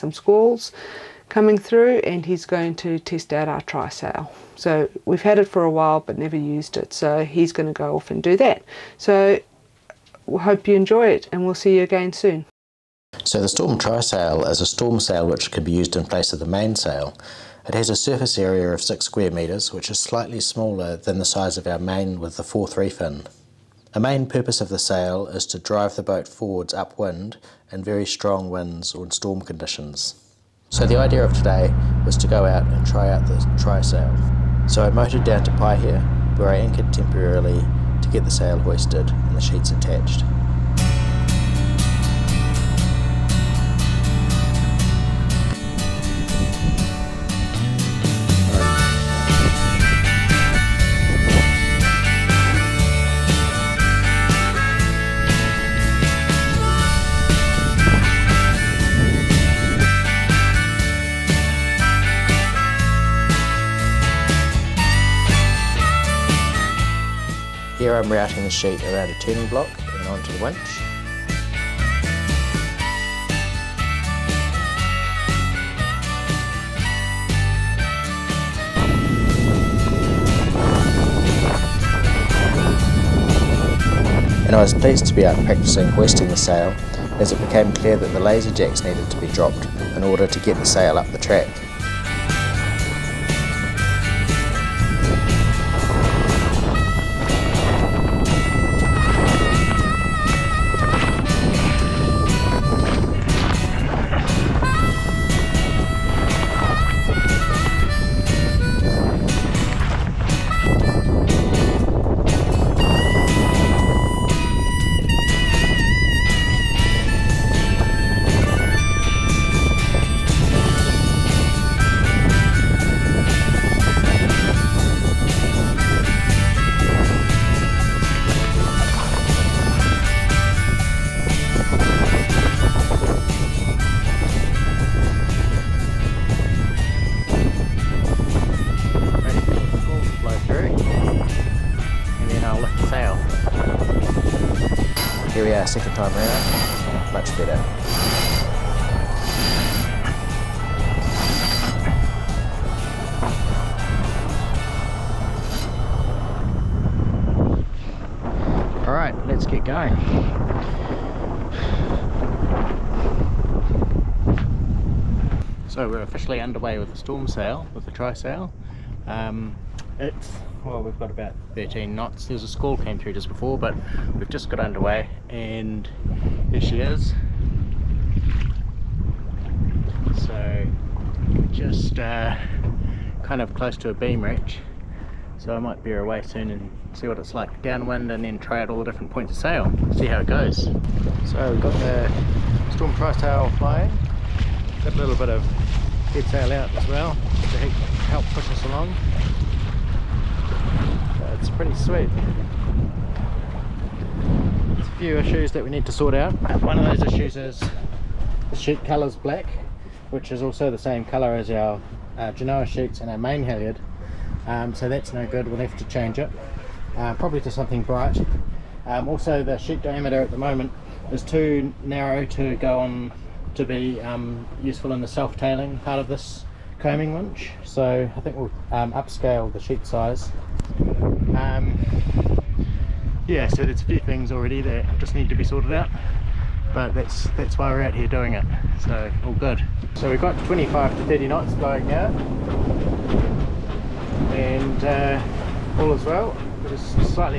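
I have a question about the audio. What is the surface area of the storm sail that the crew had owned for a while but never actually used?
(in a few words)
6 square metres.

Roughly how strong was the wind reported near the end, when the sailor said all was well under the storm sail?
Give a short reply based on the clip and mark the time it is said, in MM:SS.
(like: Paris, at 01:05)
25 to 30 knots, at 04:00.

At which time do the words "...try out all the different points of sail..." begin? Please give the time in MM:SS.
03:08.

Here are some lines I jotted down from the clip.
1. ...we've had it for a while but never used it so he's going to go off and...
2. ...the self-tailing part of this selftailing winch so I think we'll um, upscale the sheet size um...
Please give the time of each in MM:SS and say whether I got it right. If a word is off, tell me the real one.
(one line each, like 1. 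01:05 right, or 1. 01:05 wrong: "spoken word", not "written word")
1. 00:05 right
2. 03:45 wrong: "coaming", not "selftailing".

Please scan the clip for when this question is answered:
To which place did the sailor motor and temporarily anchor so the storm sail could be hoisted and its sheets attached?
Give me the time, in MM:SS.
00:35.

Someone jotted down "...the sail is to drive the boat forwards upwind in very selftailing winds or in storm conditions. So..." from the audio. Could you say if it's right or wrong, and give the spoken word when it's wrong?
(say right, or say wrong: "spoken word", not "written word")
wrong: "strong", not "selftailing".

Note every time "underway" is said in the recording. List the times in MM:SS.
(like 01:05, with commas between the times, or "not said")
02:46, 02:54.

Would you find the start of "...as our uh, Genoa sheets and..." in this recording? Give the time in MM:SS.
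03:31.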